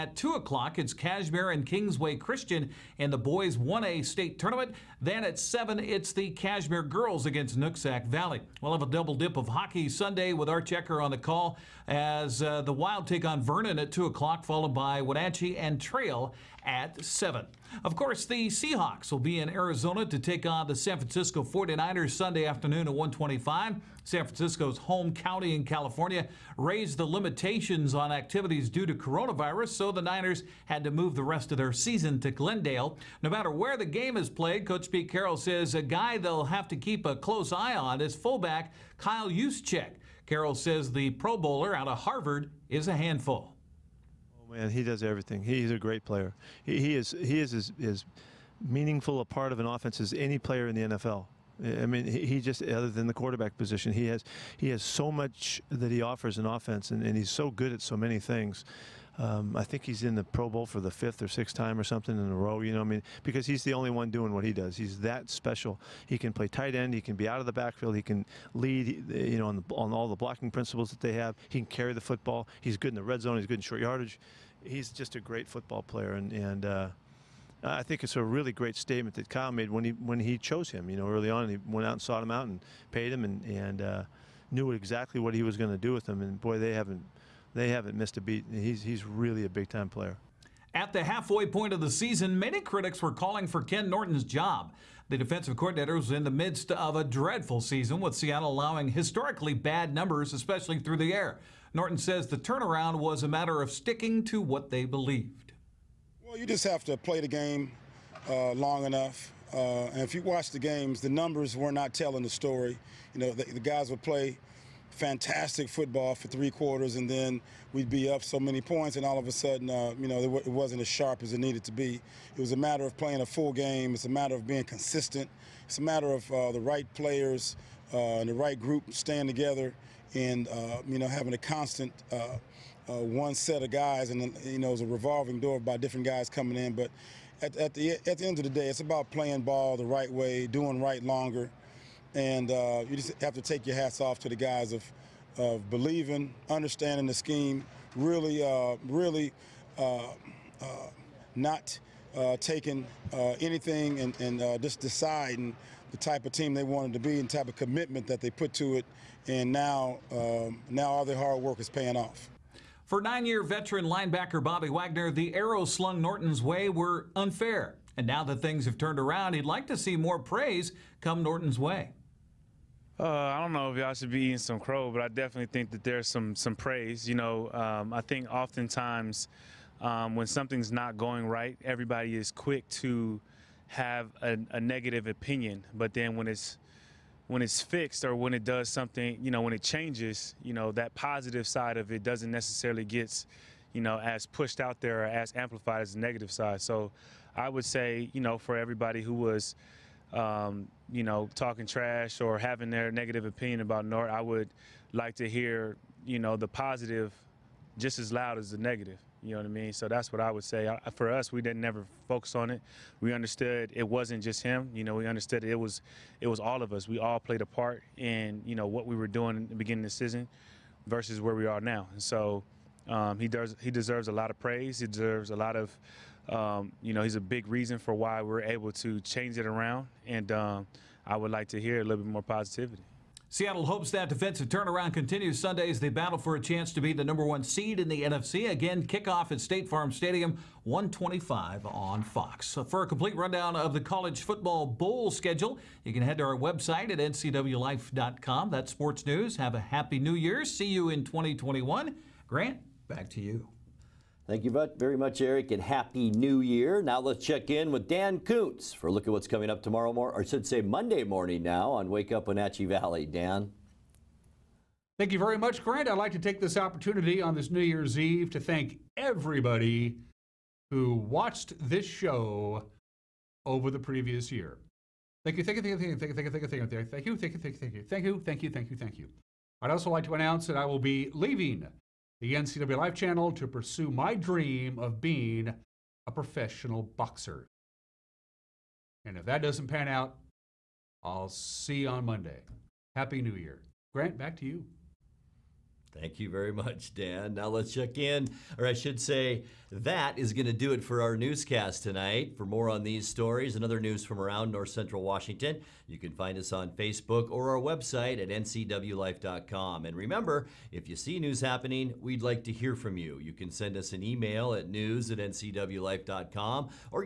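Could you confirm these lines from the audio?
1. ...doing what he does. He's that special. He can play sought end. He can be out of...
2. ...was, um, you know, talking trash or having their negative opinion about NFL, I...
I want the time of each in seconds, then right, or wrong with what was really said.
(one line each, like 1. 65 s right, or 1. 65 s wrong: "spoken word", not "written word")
1. 64 s wrong: "tight", not "sought"
2. 199 s wrong: "Nort", not "NFL".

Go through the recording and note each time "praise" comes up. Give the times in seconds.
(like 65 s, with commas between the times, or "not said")
170 s, 176 s, 224 s.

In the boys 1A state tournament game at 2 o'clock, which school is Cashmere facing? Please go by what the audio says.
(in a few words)
Kingsway Christian.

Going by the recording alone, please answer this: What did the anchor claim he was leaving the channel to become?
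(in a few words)
professional boxer.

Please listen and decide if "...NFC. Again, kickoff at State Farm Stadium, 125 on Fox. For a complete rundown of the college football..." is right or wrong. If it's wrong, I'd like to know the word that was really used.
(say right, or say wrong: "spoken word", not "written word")
right.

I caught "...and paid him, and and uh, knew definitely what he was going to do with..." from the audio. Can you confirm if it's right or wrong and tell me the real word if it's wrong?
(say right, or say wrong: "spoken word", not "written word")
wrong: "exactly", not "definitely".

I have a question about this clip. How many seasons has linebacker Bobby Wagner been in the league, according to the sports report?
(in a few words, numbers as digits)
9.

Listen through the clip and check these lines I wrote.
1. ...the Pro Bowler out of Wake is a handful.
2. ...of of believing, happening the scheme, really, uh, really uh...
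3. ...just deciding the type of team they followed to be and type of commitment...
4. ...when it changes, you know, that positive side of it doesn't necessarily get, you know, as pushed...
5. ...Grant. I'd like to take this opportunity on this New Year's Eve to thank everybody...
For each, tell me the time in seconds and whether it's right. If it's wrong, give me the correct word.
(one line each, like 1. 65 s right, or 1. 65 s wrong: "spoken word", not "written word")
1. 40 s wrong: "Harvard", not "Wake"
2. 144 s wrong: "understanding", not "happening"
3. 154 s wrong: "wanted", not "followed"
4. 189 s right
5. 265 s right.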